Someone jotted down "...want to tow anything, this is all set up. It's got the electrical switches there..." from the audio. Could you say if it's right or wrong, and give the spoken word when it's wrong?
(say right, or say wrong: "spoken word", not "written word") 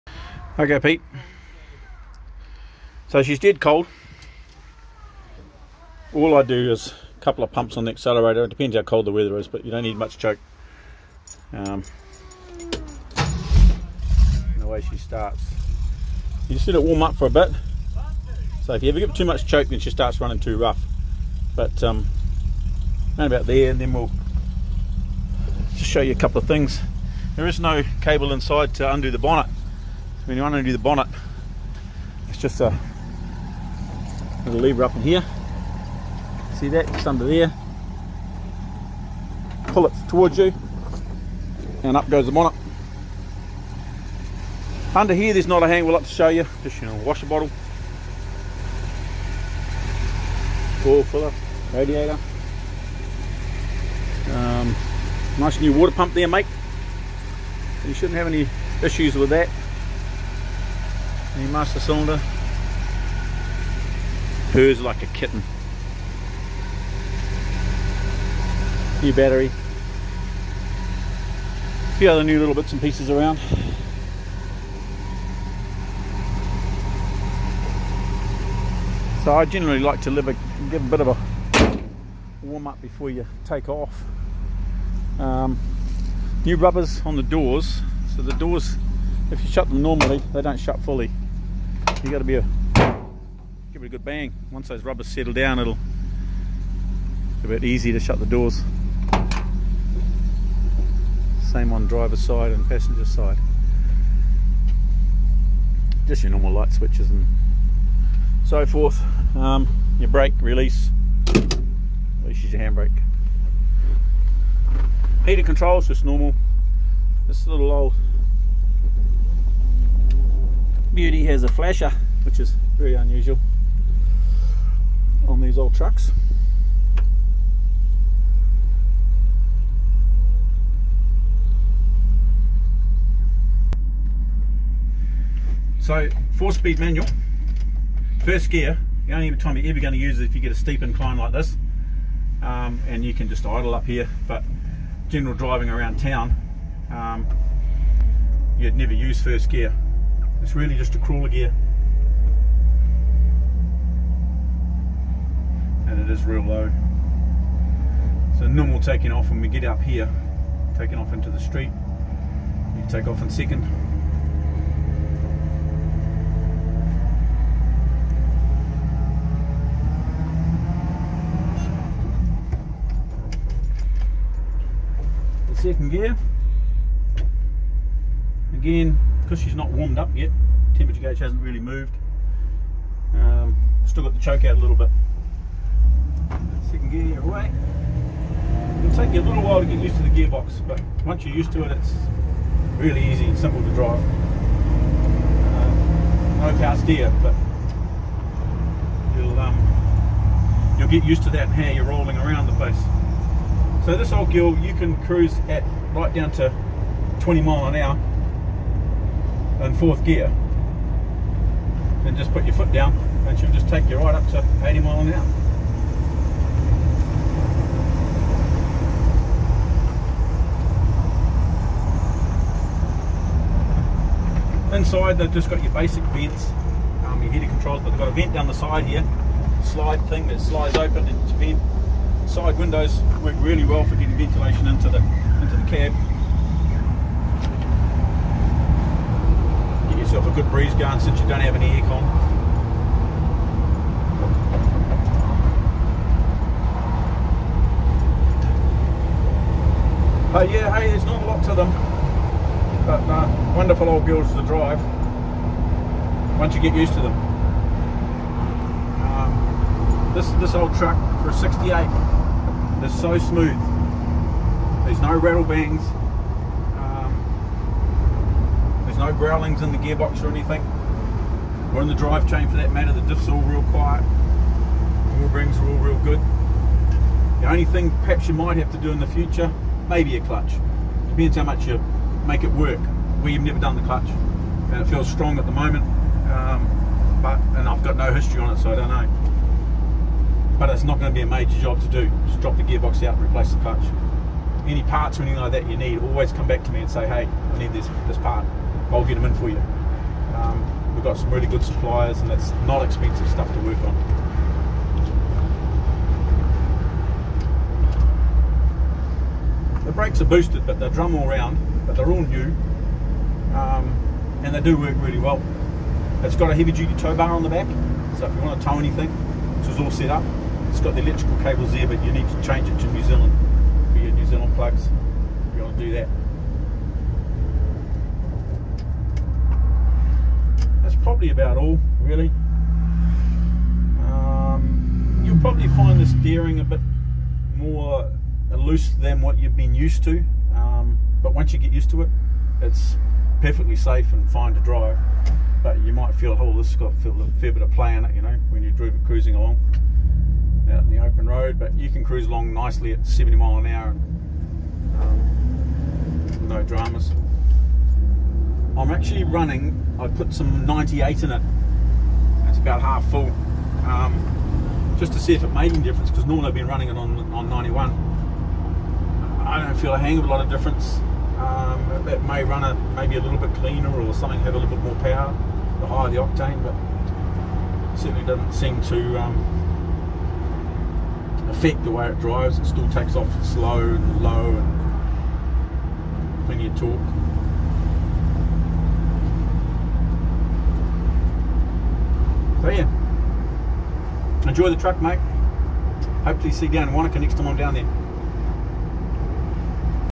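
wrong: "cables", not "switches".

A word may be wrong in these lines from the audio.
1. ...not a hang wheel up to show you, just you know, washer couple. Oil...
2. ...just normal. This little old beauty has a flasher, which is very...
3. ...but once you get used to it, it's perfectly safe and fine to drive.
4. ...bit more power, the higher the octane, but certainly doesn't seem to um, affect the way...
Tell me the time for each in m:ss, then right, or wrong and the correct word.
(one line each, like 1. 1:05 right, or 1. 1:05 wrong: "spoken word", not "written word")
1. 0:45 wrong: "bottle", not "couple"
2. 1:55 right
3. 5:41 right
4. 6:14 right.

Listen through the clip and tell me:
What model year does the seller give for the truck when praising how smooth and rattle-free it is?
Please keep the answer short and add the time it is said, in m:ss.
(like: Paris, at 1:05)
68, at 4:21.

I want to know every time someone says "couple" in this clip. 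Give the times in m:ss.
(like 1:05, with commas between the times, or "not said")
0:07, 0:26.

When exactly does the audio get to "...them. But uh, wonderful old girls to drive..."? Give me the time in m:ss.
4:11.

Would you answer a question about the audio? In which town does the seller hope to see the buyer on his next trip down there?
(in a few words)
Wanaka.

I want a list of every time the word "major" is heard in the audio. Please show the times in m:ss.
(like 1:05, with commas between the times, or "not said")
4:51.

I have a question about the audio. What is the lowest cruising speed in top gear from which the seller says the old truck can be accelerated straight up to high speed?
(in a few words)
20 mile an hour.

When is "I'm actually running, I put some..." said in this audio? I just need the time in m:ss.
5:58.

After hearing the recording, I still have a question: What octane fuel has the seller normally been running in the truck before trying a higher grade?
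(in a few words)
91.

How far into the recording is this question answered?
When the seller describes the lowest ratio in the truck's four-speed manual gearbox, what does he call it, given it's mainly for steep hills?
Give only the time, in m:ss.
2:30.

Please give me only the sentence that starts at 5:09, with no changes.
The brakes are boosted, but they are drum all round, but they're all new, um, and they do work really well.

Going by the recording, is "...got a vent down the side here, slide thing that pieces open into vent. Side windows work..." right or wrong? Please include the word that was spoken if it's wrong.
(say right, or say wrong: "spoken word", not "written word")
wrong: "slides", not "pieces".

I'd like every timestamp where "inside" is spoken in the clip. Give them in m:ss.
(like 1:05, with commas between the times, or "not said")
0:28, 3:44.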